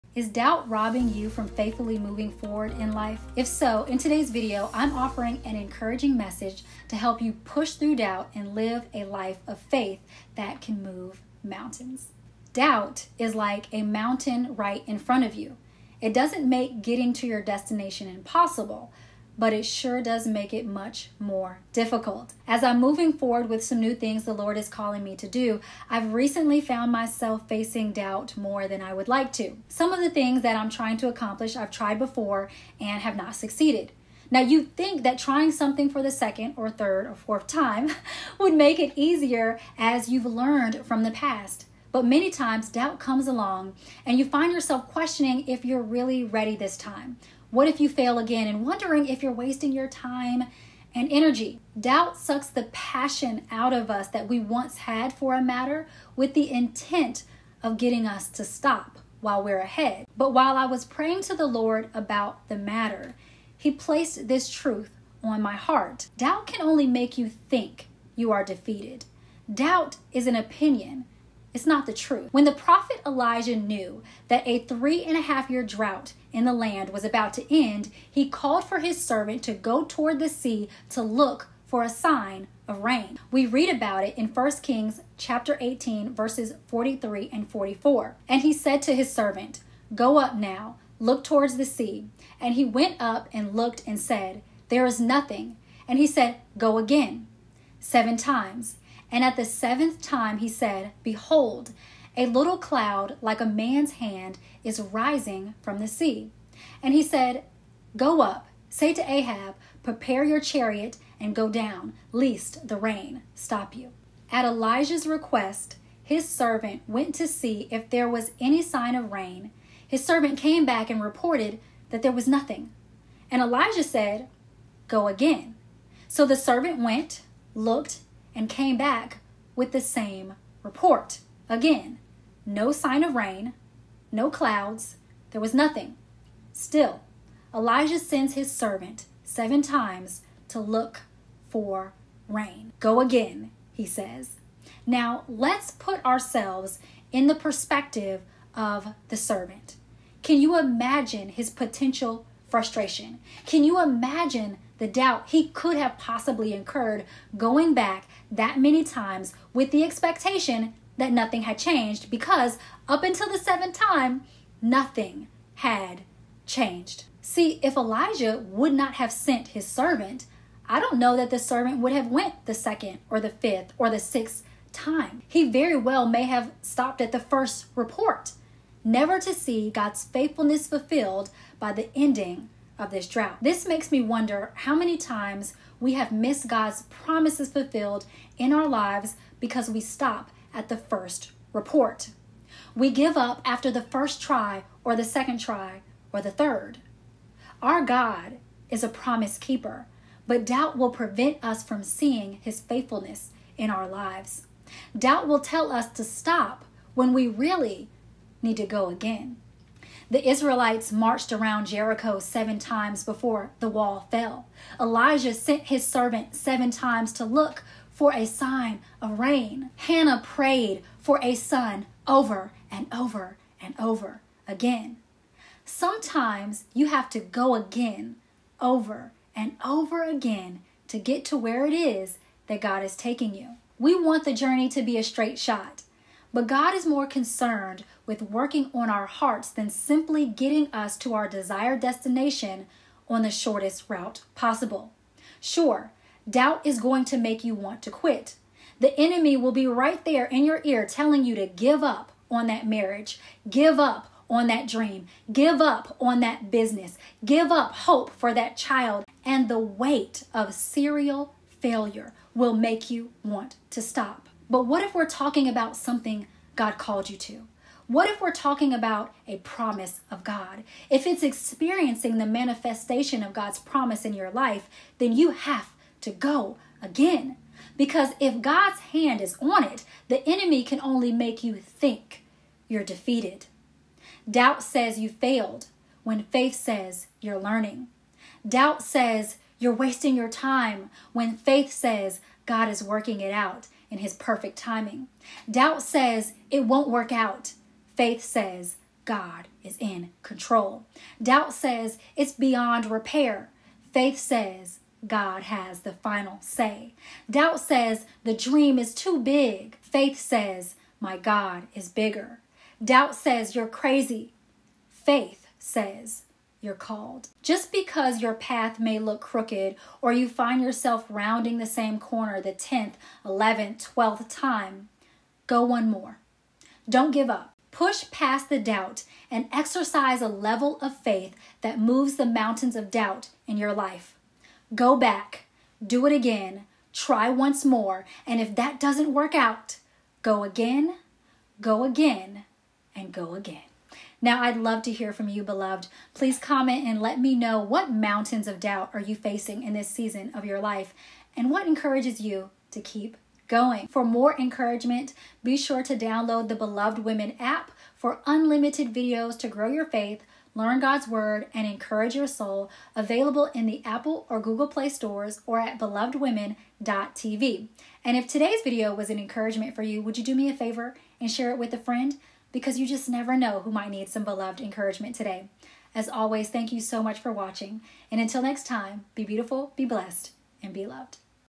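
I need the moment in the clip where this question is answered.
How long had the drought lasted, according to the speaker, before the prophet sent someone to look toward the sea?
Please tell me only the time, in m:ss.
1:14.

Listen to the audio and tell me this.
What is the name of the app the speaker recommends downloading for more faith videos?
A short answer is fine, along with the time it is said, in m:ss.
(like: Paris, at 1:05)
Beloved Women, at 5:56.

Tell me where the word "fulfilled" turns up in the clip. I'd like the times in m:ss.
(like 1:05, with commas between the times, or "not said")
3:00, 3:07.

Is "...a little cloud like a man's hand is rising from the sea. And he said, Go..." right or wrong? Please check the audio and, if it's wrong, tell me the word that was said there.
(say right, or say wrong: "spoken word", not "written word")
right.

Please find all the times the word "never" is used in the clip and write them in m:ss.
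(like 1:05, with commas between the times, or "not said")
2:58, 6:13.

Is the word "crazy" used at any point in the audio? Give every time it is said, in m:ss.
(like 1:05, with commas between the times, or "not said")
5:13.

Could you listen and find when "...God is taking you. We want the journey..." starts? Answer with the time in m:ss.
3:52.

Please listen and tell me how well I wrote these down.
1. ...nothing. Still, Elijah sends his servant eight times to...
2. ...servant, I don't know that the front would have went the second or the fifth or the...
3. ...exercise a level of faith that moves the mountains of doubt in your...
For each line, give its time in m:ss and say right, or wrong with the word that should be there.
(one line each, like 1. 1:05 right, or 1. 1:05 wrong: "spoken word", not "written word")
1. 2:15 wrong: "seven", not "eight"
2. 2:49 wrong: "servant", not "front"
3. 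5:29 right.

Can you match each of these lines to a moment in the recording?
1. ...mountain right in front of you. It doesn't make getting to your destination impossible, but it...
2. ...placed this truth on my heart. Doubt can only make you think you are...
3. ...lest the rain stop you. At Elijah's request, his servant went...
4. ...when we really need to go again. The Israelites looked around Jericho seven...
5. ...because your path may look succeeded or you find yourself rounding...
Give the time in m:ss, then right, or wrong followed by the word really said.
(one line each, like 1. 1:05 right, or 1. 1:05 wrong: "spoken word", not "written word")
1. 0:13 right
2. 1:03 right
3. 1:52 right
4. 3:26 wrong: "marched", not "looked"
5. 5:17 wrong: "crooked", not "succeeded".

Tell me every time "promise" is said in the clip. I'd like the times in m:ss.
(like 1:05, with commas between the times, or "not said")
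3:06, 3:18, 4:29, 4:33.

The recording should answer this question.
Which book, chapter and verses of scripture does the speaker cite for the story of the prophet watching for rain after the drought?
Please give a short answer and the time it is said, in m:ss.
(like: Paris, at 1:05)
1 Kings 18:43-44, at 1:24.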